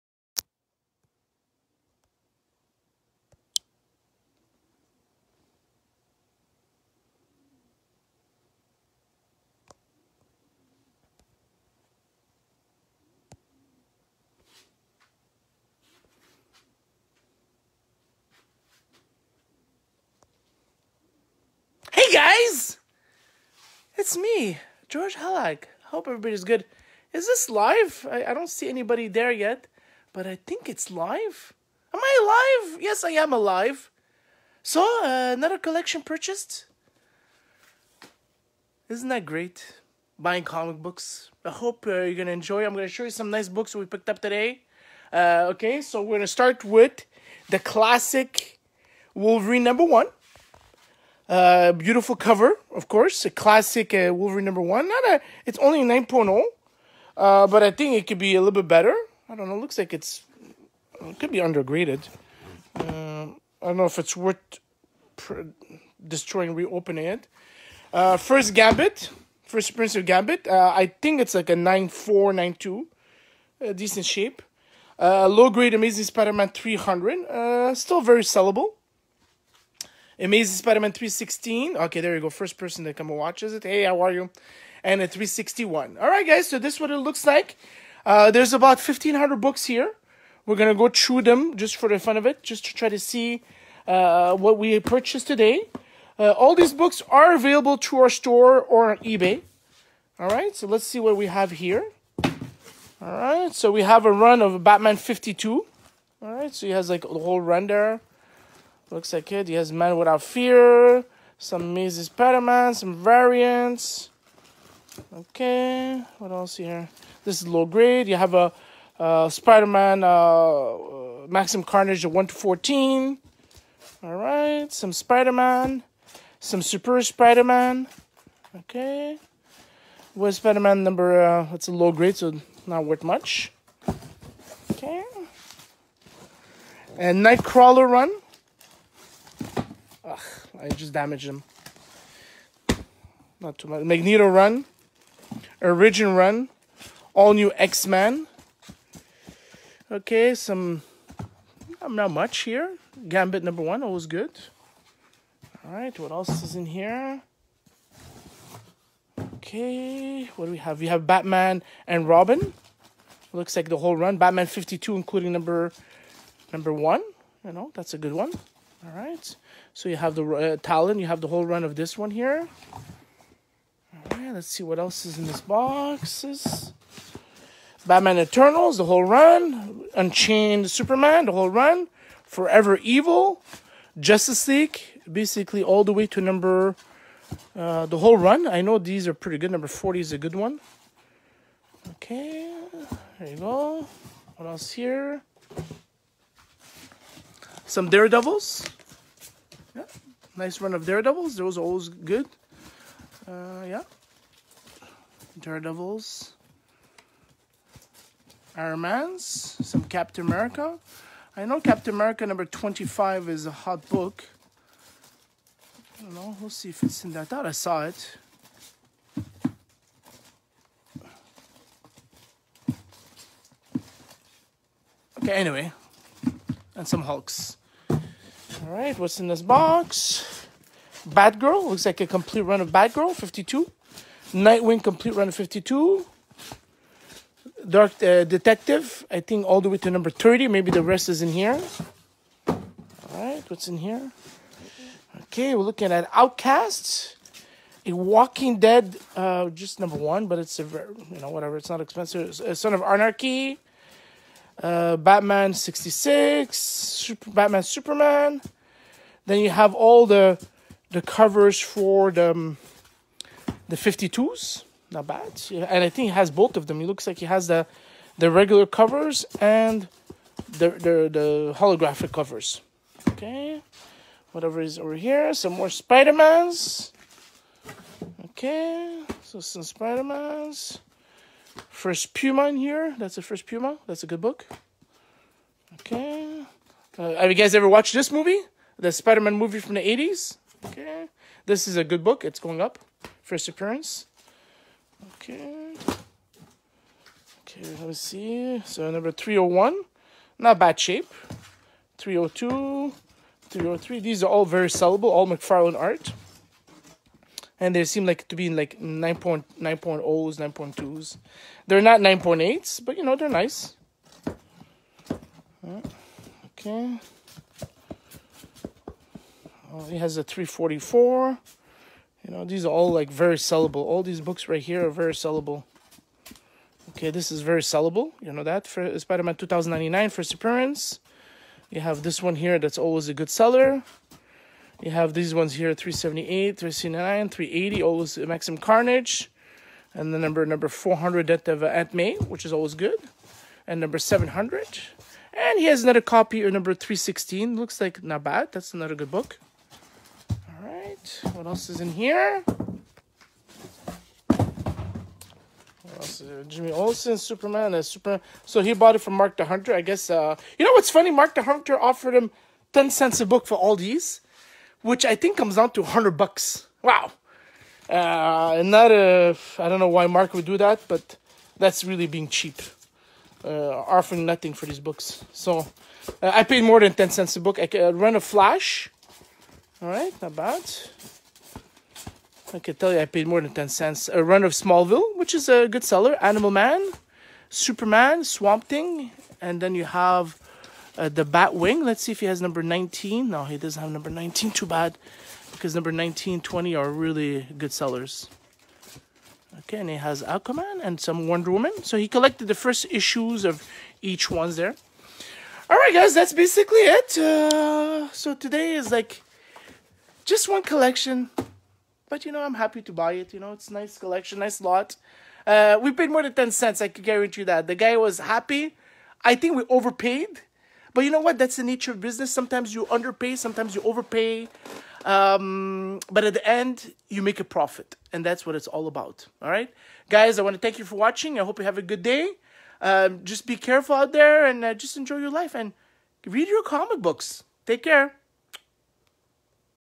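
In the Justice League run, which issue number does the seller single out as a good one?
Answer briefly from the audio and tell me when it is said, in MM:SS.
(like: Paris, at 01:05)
40, at 03:09.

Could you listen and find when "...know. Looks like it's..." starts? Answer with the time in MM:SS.
00:59.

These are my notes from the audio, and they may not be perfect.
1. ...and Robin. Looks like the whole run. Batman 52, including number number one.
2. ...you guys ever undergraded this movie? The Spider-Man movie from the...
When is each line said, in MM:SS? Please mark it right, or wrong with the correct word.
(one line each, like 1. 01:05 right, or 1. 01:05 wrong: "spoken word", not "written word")
1. 02:41 right
2. 04:47 wrong: "watched", not "undergraded".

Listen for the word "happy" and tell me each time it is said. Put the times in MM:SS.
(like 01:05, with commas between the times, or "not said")
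06:52, 06:58.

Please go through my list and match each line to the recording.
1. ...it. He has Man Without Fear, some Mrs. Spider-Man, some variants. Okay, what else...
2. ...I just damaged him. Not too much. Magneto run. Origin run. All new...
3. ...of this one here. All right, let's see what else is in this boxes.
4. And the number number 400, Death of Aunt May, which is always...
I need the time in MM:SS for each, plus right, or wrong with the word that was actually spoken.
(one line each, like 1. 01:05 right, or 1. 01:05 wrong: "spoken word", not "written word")
1. 01:49 right
2. 02:20 right
3. 02:51 right
4. 05:39 right.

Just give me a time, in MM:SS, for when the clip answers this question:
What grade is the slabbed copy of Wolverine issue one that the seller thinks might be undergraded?
00:55.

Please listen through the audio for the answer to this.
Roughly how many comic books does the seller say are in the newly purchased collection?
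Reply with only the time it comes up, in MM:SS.
01:28.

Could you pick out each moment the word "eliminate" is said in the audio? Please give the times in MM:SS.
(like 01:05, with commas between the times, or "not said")
not said.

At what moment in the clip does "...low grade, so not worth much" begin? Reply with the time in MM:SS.
02:11.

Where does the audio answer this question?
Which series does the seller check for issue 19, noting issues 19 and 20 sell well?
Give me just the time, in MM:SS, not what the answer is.
06:31.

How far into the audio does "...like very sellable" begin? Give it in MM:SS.
05:22.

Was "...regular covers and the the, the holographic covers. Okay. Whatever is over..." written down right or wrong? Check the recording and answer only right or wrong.
right.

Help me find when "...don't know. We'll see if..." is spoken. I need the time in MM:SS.
03:36.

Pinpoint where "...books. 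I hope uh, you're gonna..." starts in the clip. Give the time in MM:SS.
00:40.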